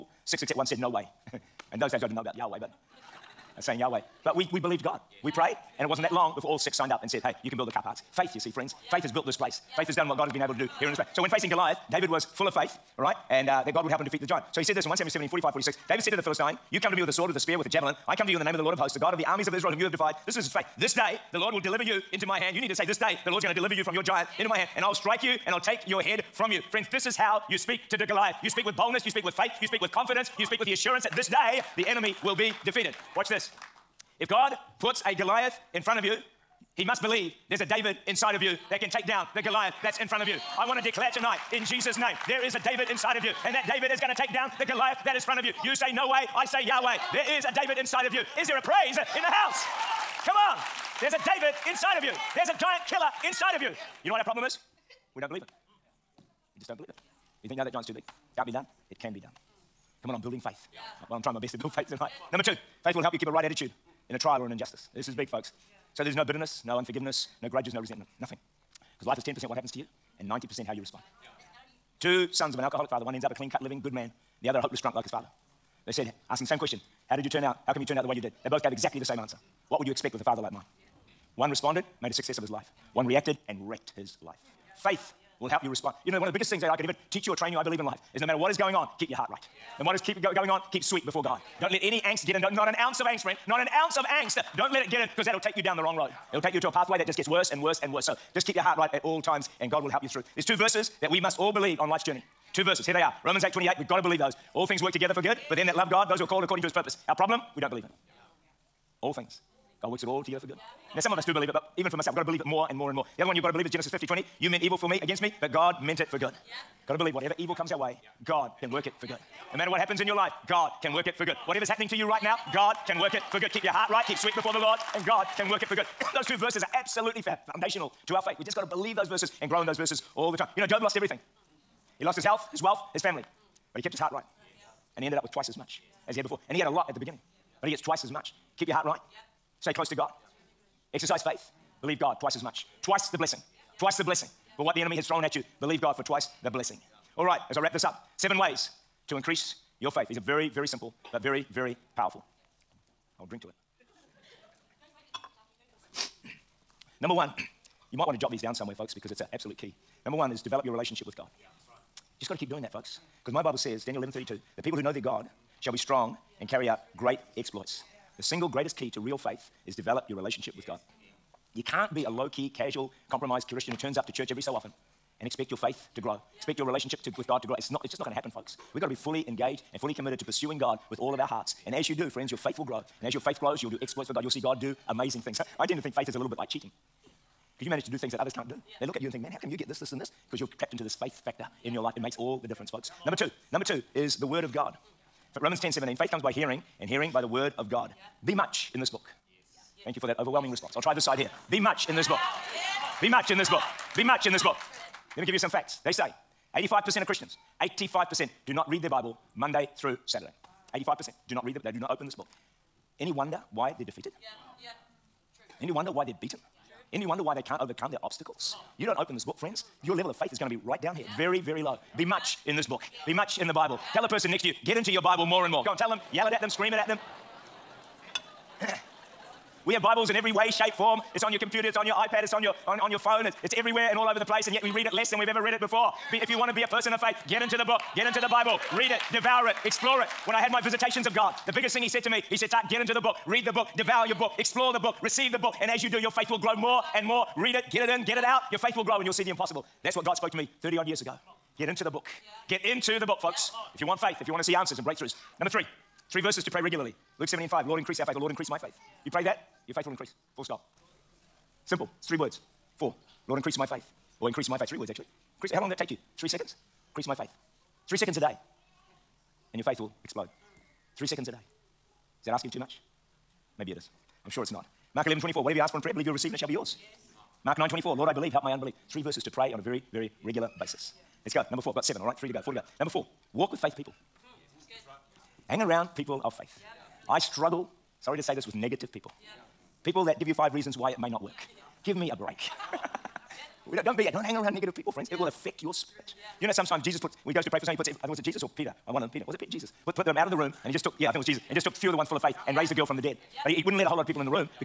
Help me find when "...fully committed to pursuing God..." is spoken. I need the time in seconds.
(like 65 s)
179 s.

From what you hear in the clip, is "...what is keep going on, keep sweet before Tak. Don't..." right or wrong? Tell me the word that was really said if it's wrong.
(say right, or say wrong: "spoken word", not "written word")
wrong: "God", not "Tak".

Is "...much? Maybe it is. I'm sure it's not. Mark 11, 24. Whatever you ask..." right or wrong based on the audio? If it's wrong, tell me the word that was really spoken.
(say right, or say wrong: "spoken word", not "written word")
right.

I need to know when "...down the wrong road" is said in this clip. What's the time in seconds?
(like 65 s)
95 s.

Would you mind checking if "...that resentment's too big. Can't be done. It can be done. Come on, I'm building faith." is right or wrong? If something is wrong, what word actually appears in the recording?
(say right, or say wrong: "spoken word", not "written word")
wrong: "giant", not "resentment".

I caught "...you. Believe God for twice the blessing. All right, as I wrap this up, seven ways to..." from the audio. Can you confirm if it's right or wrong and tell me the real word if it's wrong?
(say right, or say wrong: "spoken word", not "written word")
right.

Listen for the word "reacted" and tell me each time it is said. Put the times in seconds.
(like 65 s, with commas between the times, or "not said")
83 s.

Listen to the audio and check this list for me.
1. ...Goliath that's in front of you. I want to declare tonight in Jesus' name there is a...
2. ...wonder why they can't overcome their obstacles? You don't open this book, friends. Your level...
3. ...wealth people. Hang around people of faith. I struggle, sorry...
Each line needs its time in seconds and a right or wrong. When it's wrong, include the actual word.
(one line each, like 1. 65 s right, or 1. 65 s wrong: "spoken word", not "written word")
1. 39 s right
2. 217 s right
3. 283 s wrong: "faith", not "wealth".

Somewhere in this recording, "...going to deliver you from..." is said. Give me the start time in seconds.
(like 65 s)
23 s.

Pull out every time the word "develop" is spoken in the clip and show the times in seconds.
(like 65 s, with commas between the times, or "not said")
160 s, 169 s.